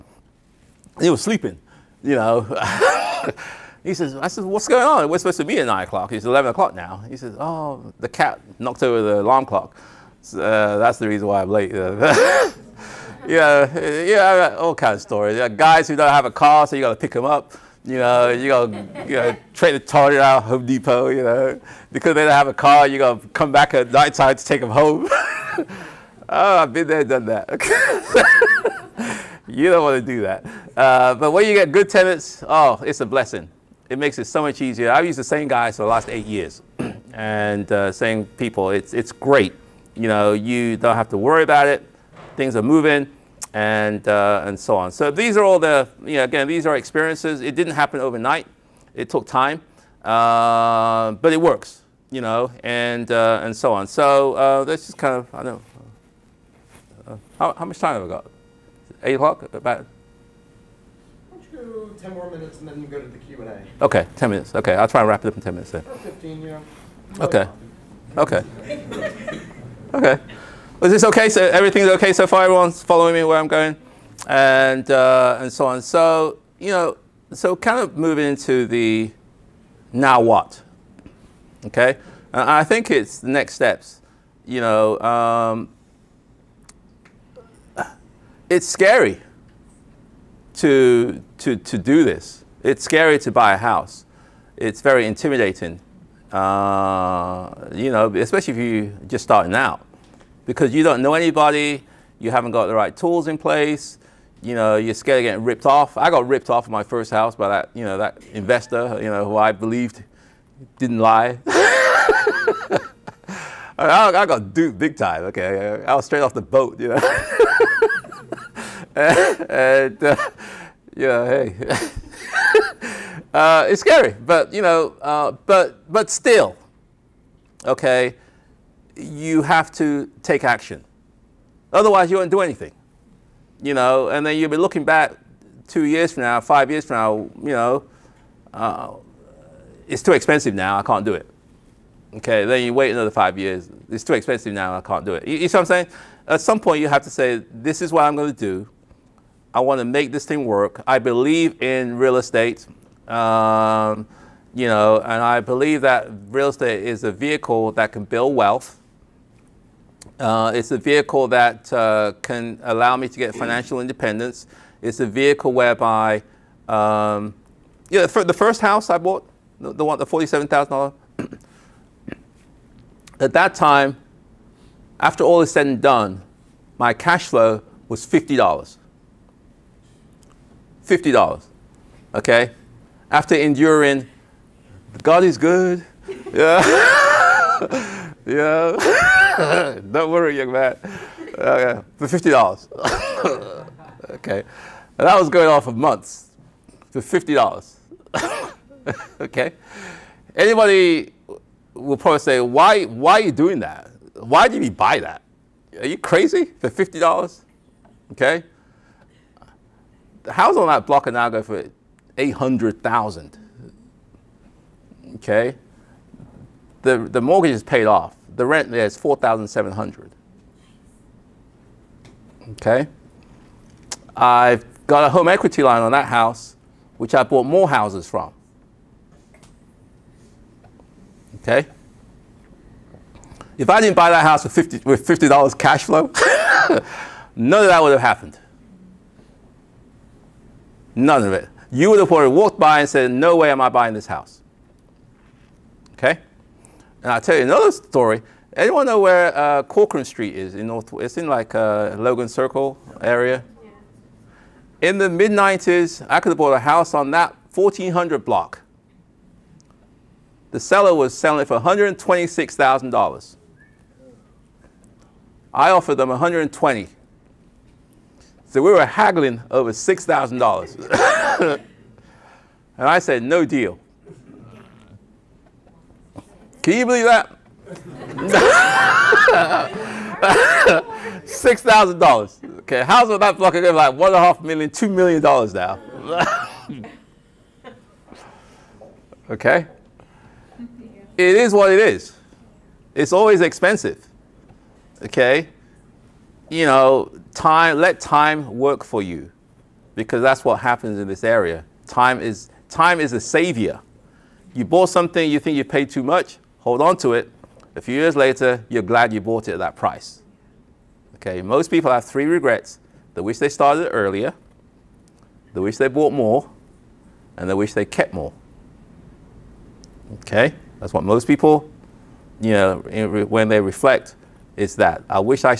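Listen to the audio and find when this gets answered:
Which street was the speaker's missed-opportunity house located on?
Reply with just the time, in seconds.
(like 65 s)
249 s.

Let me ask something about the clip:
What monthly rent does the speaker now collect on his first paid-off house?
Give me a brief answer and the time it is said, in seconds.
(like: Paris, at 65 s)
$4,700, at 218 s.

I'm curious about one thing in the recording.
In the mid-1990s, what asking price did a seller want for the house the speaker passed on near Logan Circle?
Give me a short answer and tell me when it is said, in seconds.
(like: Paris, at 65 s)
$126,000, at 261 s.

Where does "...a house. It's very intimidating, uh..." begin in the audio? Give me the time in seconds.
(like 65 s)
93 s.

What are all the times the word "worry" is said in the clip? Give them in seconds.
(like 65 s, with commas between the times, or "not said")
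41 s, 190 s.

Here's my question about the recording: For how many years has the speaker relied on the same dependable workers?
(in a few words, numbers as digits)
8.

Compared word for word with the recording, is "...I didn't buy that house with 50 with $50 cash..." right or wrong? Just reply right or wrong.
right.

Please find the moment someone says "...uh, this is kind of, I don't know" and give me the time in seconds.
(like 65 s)
54 s.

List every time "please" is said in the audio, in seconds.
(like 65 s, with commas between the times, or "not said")
not said.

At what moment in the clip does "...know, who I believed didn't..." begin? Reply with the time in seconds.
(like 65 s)
109 s.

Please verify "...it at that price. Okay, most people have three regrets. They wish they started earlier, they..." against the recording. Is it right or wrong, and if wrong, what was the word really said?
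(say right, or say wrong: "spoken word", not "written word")
right.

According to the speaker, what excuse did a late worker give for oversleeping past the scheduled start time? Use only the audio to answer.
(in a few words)
The cat knocked over the alarm clock.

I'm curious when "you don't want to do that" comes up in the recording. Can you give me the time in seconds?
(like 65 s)
29 s.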